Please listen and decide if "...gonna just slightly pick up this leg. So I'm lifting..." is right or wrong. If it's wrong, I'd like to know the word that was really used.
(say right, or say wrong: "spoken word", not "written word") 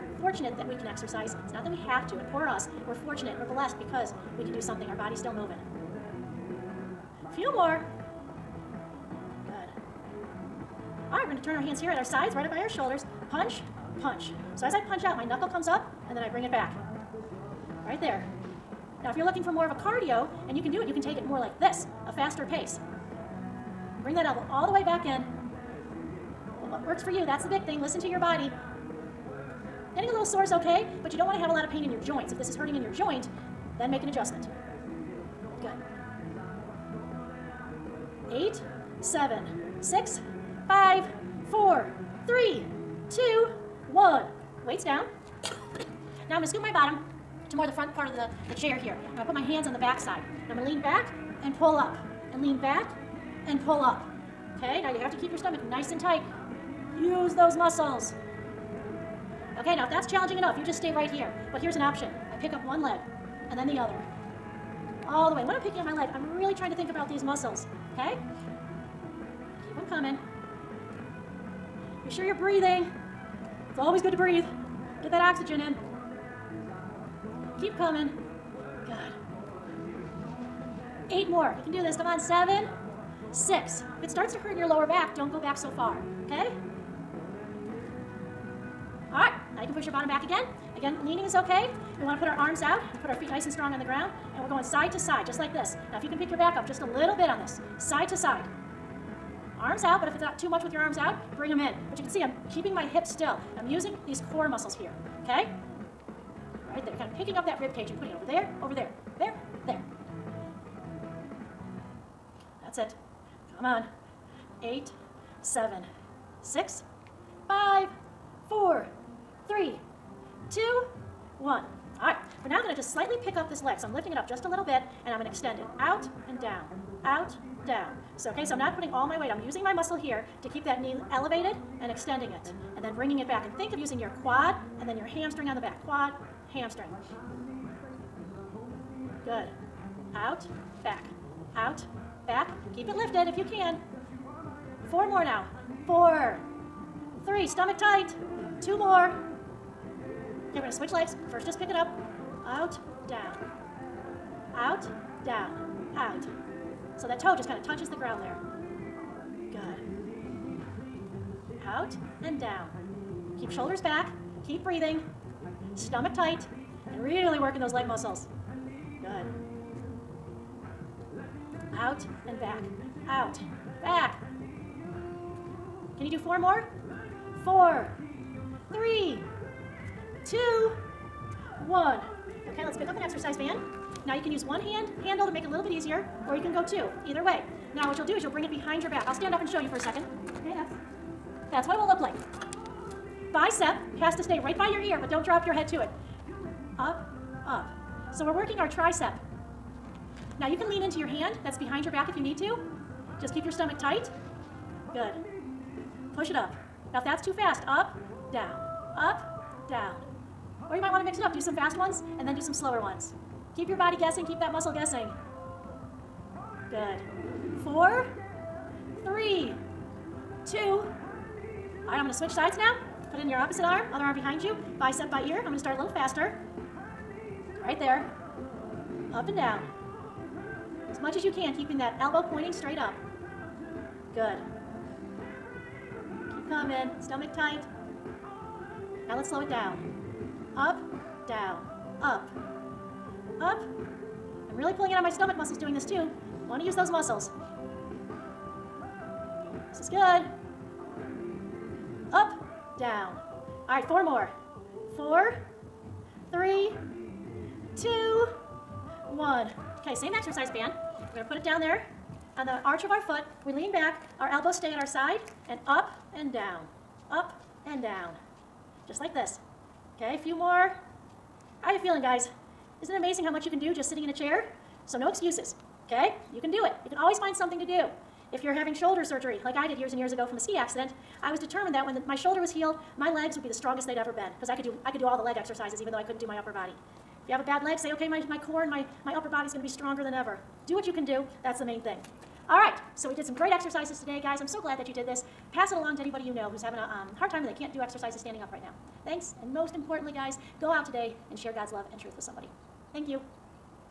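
right.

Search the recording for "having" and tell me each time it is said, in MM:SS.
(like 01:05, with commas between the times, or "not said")
04:38, 04:56.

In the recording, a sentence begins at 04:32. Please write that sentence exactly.
Isn't it amazing how much you can do just sitting in a chair?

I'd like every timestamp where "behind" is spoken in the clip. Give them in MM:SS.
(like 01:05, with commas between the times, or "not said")
03:08, 03:21, 03:44.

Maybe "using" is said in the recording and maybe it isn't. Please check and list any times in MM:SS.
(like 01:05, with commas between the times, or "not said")
01:43, 02:09, 02:13.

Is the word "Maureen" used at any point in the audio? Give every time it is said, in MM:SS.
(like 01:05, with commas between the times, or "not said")
not said.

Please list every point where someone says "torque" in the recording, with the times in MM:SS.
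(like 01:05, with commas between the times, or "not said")
not said.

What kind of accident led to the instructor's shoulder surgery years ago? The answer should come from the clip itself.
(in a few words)
ski accident.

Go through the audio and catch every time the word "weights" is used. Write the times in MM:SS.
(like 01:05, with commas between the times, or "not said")
00:44, 02:09.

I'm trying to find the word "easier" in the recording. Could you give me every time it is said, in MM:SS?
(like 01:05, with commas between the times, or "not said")
03:05.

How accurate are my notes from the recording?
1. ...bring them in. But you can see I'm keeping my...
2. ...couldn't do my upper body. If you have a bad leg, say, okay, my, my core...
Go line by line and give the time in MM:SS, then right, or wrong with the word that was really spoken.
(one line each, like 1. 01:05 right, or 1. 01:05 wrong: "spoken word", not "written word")
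1. 01:41 right
2. 04:46 right.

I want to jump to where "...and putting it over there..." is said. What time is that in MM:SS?
01:47.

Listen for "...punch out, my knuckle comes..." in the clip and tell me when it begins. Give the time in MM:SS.
00:14.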